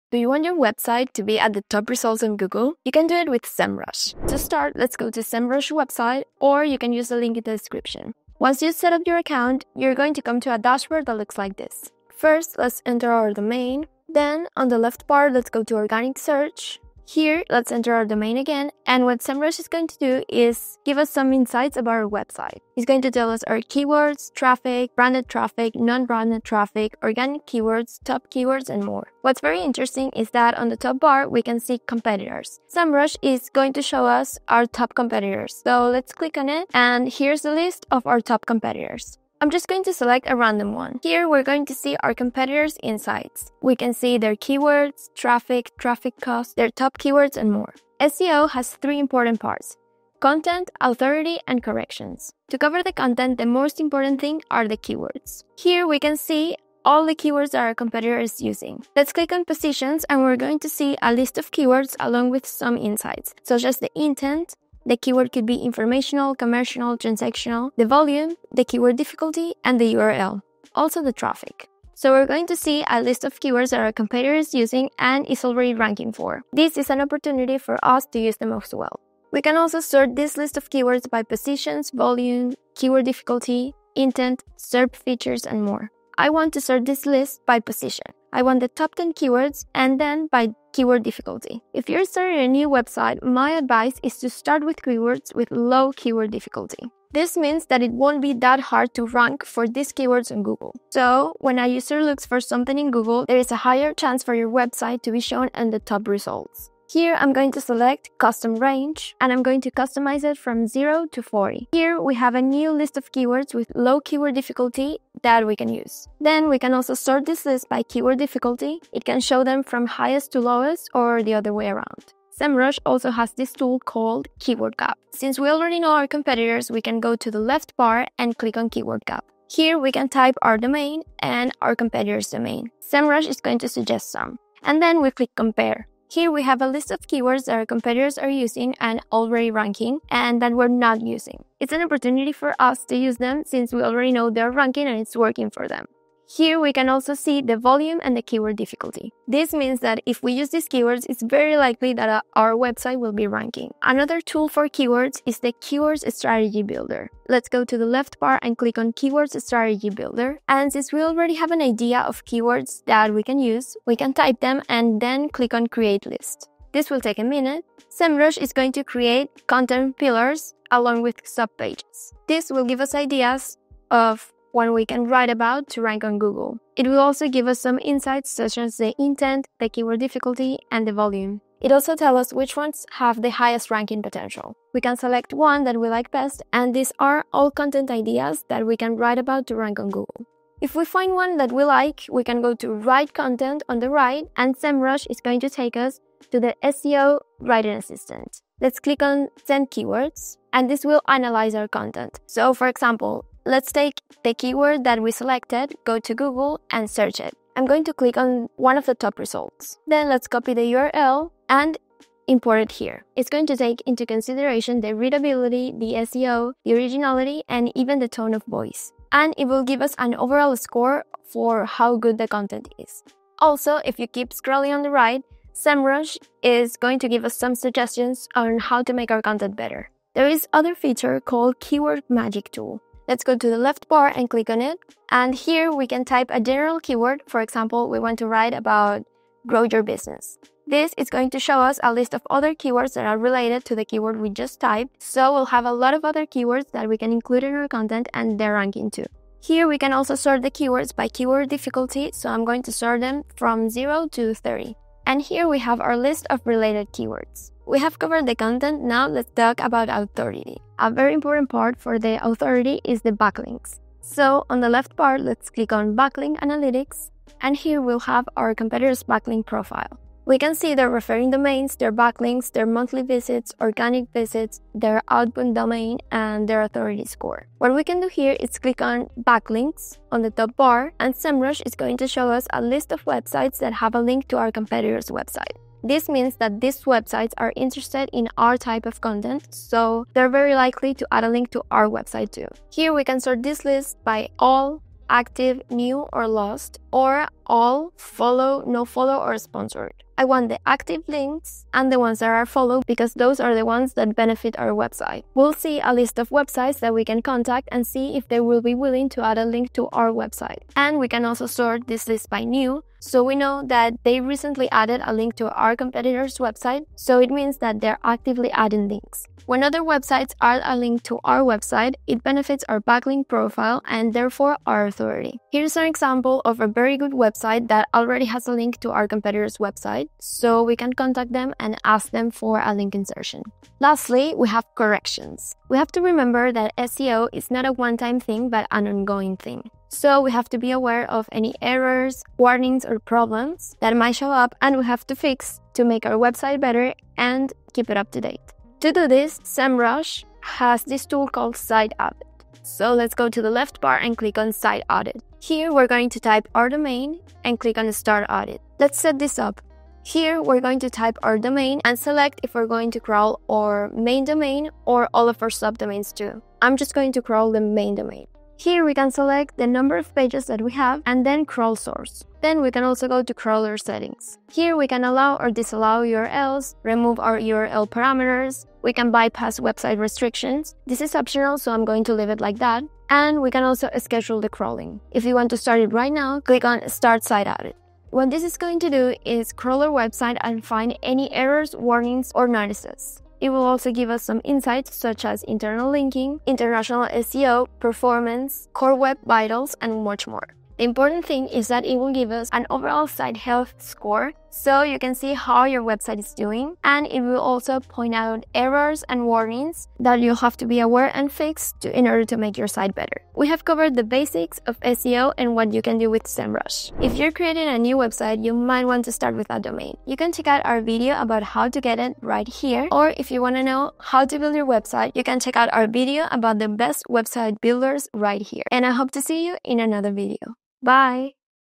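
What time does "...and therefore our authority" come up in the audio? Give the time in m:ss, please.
5:23.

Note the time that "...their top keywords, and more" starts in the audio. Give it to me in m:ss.
0:46.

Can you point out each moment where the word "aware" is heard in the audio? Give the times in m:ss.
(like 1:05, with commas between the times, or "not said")
5:40, 6:50.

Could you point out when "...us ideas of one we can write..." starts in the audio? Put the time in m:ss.
2:52.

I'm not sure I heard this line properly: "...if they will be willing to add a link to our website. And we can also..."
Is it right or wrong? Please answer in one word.
right.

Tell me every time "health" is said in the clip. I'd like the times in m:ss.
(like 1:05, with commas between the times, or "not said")
6:43.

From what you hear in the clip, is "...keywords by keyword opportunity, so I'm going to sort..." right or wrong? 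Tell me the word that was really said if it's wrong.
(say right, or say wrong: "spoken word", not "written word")
wrong: "difficulty", not "opportunity".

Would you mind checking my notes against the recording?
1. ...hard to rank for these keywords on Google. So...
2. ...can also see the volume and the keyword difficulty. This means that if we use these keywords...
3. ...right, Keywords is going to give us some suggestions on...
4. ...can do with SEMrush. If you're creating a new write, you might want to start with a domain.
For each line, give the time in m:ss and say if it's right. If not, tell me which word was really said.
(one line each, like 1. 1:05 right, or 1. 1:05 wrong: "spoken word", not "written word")
1. 1:38 right
2. 2:26 right
3. 3:44 wrong: "SEMrush", not "Keywords"
4. 6:55 wrong: "website", not "write".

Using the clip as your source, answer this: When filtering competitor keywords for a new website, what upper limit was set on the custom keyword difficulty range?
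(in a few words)
40.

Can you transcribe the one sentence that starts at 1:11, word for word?
So we're going to see a list of keywords that our is using and is already ranking for.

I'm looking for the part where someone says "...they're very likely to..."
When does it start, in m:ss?
4:50.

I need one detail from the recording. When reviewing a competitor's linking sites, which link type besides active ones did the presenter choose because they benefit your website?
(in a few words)
followed.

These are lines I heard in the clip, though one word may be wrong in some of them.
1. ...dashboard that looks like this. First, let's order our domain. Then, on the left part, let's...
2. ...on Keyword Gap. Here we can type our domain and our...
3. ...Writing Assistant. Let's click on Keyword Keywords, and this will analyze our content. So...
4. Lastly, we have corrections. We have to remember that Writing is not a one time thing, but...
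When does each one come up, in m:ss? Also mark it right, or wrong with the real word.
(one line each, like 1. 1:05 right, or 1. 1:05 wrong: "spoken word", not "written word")
1. 0:10 wrong: "enter", not "order"
2. 2:08 right
3. 3:17 wrong: "Send", not "Keyword"
4. 5:33 wrong: "SEO", not "Writing".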